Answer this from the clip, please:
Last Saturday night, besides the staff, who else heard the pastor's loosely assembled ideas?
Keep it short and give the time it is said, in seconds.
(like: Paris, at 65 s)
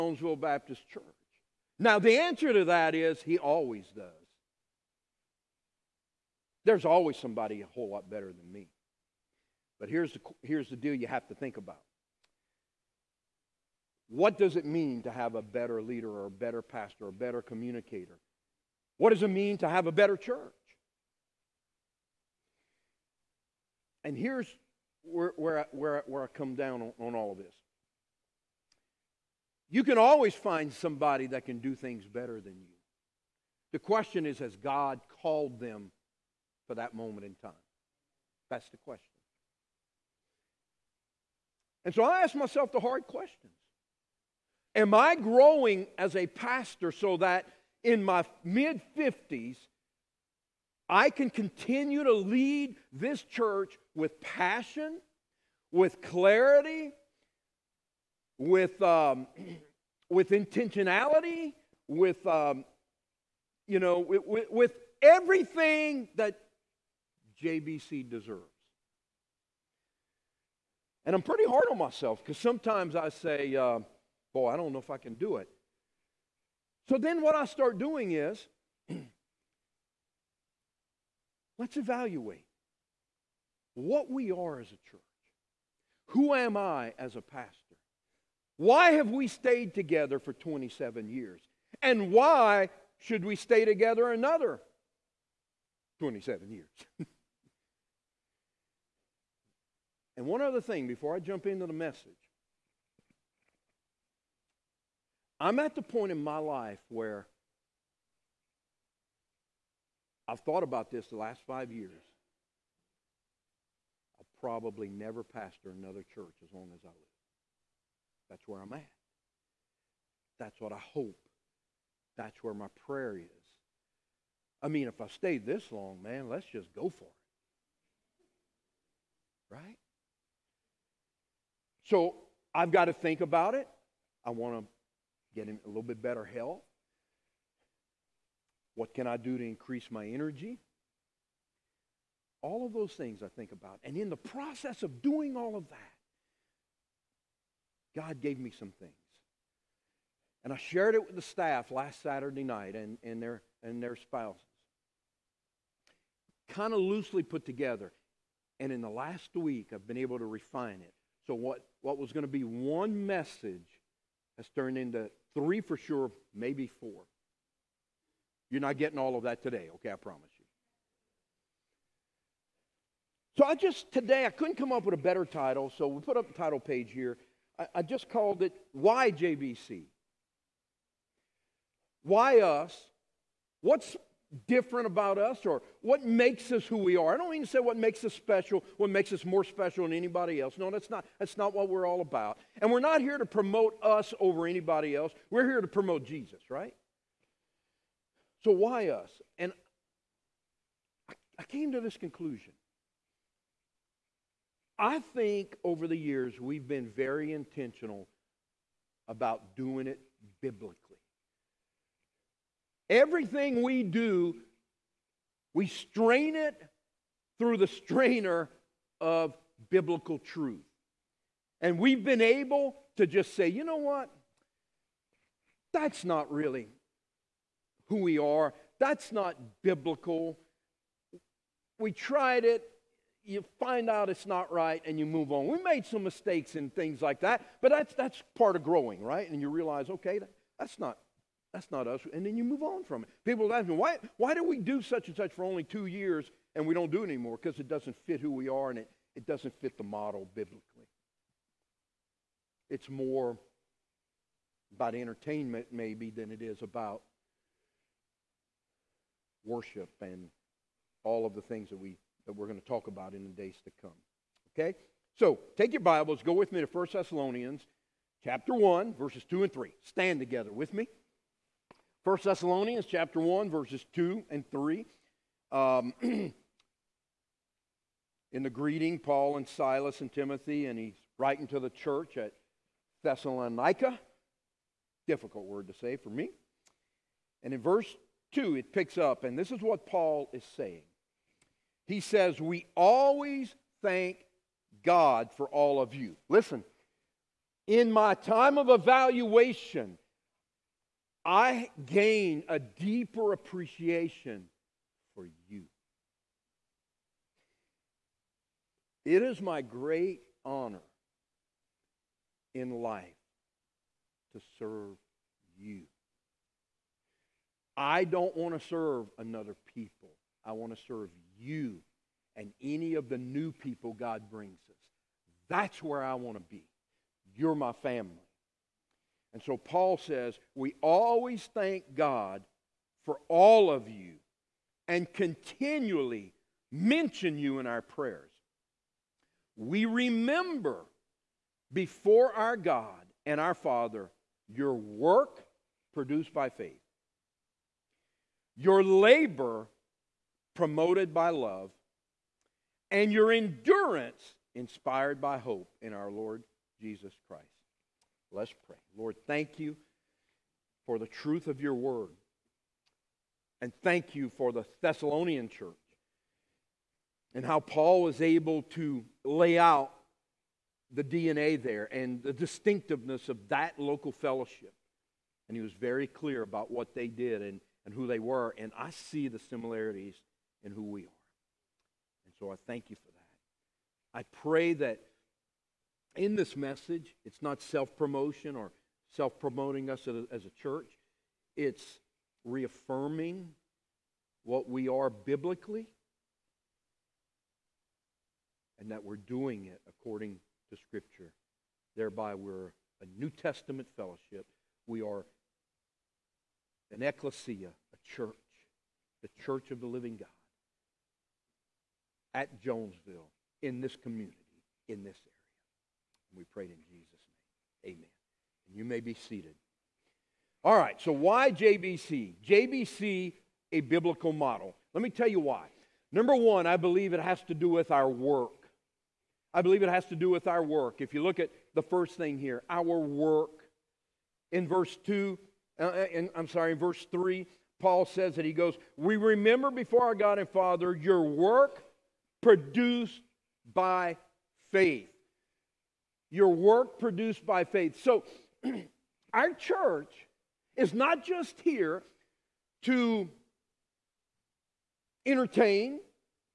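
Their spouses, at 153 s.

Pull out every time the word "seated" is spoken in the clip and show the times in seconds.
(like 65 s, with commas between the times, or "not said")
419 s.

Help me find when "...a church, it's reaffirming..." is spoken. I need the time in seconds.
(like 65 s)
390 s.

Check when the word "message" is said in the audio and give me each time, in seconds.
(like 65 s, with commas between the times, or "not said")
101 s, 163 s, 386 s.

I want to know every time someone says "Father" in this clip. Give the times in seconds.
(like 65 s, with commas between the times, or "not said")
343 s, 440 s.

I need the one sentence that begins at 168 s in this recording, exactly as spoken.
You're not getting all of that today, okay, I promise you.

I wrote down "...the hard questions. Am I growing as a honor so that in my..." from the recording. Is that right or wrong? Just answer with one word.
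wrong.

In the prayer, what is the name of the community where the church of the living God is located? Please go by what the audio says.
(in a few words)
Jonesville.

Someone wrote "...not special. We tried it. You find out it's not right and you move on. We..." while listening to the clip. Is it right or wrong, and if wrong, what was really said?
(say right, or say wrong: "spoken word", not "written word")
wrong: "biblical", not "special".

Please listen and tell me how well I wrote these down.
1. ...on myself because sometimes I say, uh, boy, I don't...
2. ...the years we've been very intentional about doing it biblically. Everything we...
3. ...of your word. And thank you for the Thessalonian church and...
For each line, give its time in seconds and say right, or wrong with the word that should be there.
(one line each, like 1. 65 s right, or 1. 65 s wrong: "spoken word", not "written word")
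1. 71 s right
2. 205 s right
3. 361 s right.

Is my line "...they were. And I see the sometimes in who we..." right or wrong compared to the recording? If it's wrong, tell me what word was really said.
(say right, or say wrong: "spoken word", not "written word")
wrong: "similarities", not "sometimes".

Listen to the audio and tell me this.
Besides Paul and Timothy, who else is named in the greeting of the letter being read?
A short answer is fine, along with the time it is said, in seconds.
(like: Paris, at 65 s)
Silas, at 279 s.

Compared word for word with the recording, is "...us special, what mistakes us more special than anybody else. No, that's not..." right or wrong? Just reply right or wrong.
wrong.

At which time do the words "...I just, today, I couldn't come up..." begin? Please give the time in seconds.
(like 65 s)
173 s.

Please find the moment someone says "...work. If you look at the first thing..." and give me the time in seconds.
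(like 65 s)
430 s.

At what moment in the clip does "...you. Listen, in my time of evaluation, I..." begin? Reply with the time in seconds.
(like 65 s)
295 s.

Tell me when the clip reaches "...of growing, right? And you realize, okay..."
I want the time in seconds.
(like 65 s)
238 s.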